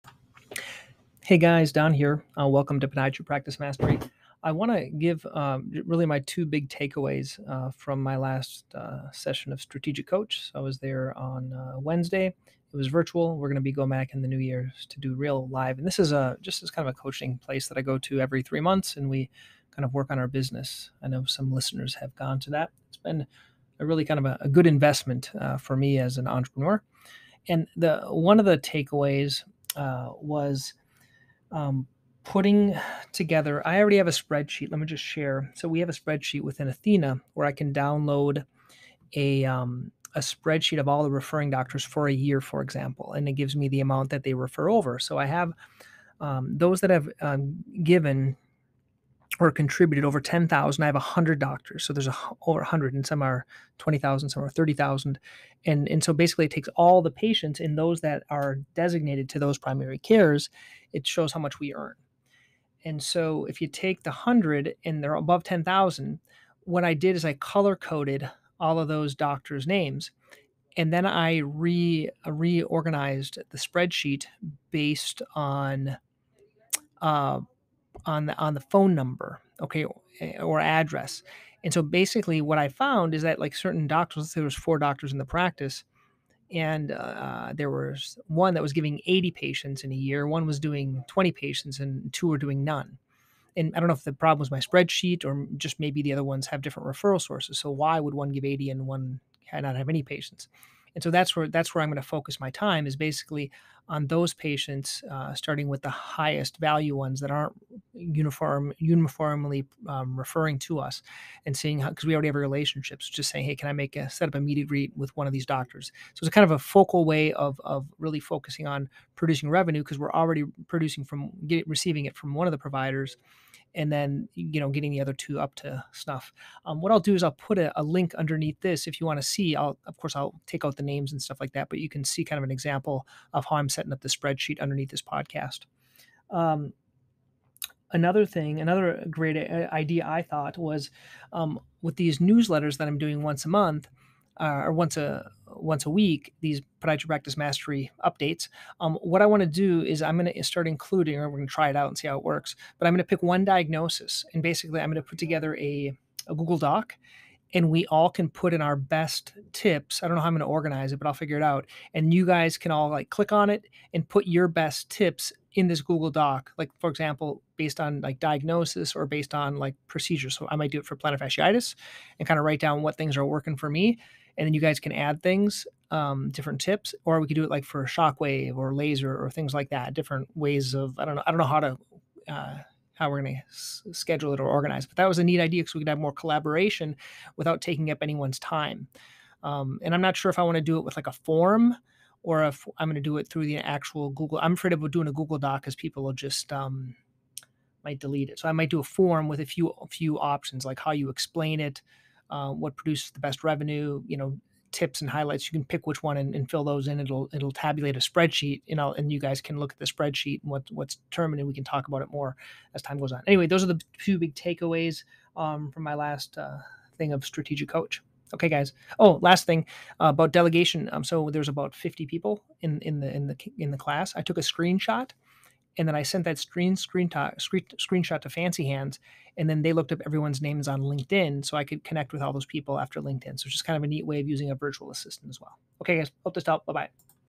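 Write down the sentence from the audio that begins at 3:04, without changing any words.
But that was a neat idea because we could have more collaboration without taking up anyone's time.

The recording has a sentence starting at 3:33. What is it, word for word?
Anyway, those are the two big takeaways um, from my last uh, thing of strategic coach.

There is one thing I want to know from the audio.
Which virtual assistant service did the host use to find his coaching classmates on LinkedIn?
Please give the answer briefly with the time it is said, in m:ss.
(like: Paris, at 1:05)
Fancy Hands, at 3:48.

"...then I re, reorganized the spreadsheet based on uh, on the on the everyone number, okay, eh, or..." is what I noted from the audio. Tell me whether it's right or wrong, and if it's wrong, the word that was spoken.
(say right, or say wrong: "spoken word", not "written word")
wrong: "phone", not "everyone".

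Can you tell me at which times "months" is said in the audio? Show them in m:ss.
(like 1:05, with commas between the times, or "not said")
0:18, 2:23.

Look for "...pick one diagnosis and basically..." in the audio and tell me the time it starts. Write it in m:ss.
2:33.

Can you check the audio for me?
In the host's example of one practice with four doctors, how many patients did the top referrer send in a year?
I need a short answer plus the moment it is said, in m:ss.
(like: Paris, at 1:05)
80, at 1:29.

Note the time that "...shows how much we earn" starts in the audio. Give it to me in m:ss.
1:01.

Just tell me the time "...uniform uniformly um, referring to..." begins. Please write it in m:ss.
1:47.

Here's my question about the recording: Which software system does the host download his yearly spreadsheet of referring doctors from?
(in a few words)
Athena.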